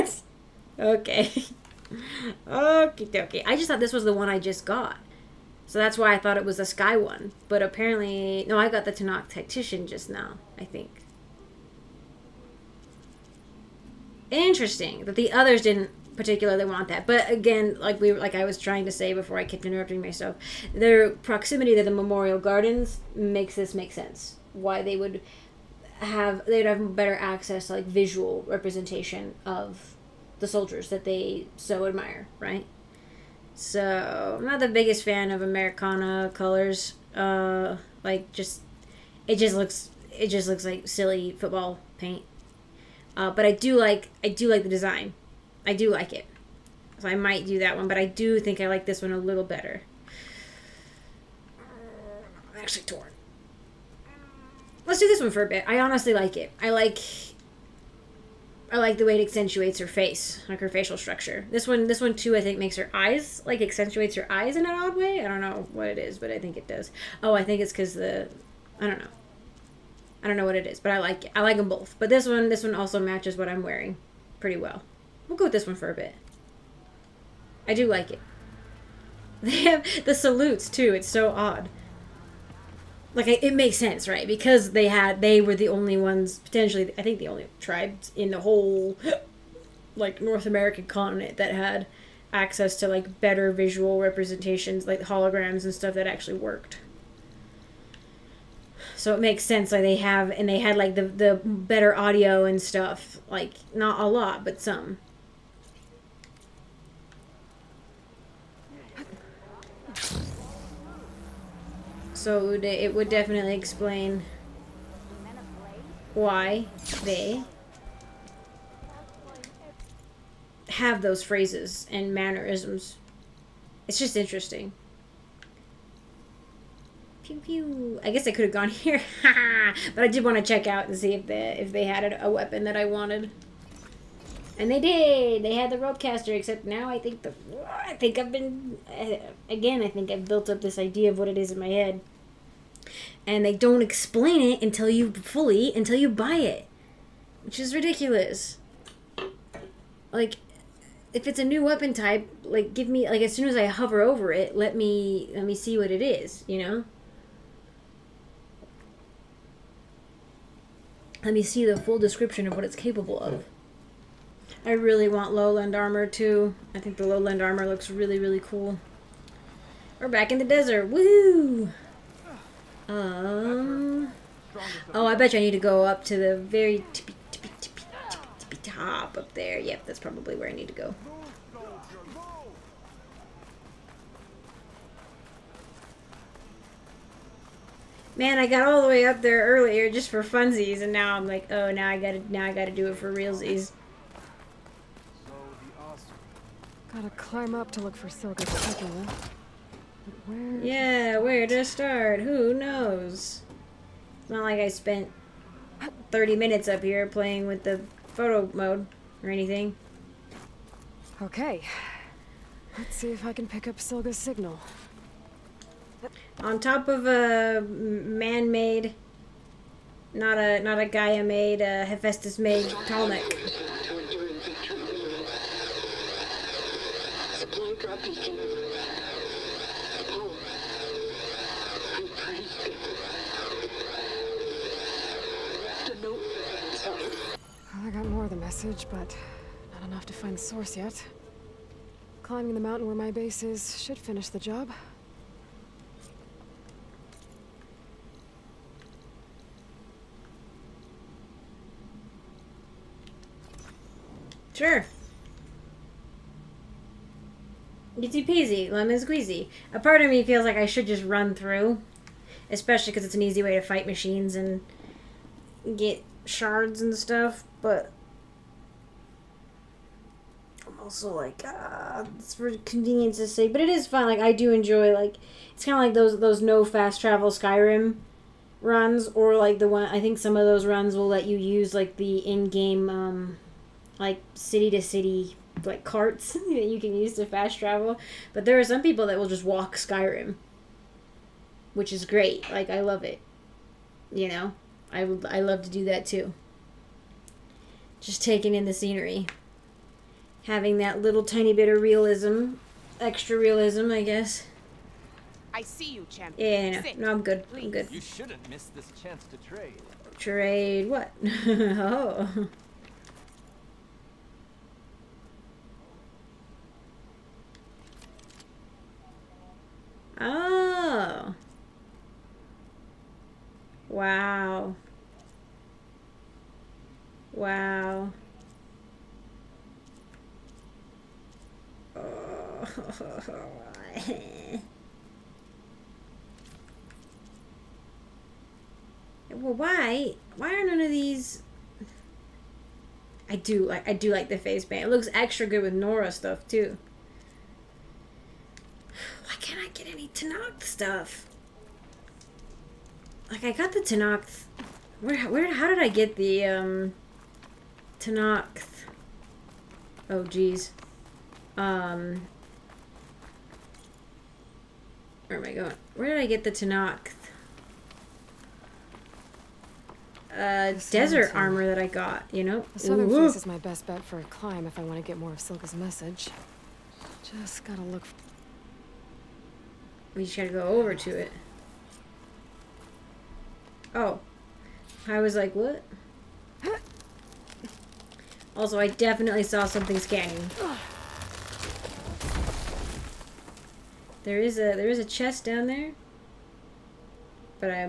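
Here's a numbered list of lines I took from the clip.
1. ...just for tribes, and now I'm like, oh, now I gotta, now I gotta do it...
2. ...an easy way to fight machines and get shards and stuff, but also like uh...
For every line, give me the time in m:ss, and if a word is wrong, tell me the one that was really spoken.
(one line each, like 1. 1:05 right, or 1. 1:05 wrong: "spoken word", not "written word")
1. 3:09 wrong: "funsies", not "tribes"
2. 4:23 right.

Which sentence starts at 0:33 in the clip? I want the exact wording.
So I'm not the biggest fan of Americana colors.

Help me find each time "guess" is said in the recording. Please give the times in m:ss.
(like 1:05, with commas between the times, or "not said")
2:08, 5:04.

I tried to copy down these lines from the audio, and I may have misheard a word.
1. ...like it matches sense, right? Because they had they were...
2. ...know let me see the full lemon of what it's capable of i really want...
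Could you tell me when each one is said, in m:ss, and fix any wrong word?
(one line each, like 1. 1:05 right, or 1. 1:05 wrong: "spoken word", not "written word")
1. 1:23 wrong: "makes", not "matches"
2. 2:36 wrong: "description", not "lemon".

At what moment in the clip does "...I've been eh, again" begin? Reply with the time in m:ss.
2:18.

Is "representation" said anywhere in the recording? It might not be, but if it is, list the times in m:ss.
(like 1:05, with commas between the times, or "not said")
0:28, 1:33.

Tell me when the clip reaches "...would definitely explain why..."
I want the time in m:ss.
1:52.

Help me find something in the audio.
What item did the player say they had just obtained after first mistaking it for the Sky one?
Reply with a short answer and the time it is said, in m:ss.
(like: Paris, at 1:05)
Tenakth Tactician, at 0:08.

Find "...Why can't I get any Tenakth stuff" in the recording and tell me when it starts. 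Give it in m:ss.
5:48.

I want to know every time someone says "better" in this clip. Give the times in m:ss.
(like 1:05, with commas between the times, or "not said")
0:26, 0:49, 1:33, 1:41.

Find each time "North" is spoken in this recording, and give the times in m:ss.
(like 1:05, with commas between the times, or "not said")
1:30.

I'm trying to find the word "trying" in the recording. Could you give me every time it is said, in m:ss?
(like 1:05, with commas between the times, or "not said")
0:18.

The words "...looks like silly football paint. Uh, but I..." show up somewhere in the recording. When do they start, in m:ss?
0:40.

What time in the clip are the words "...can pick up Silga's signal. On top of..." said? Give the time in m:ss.
3:33.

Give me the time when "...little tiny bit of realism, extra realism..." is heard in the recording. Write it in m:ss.
5:01.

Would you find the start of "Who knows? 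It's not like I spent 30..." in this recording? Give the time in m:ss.
3:22.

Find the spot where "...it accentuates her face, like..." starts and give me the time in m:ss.
0:59.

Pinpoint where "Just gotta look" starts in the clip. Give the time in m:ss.
6:17.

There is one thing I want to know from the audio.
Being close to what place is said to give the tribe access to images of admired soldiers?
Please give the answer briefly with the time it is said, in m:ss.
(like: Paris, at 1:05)
memorial gardens, at 0:21.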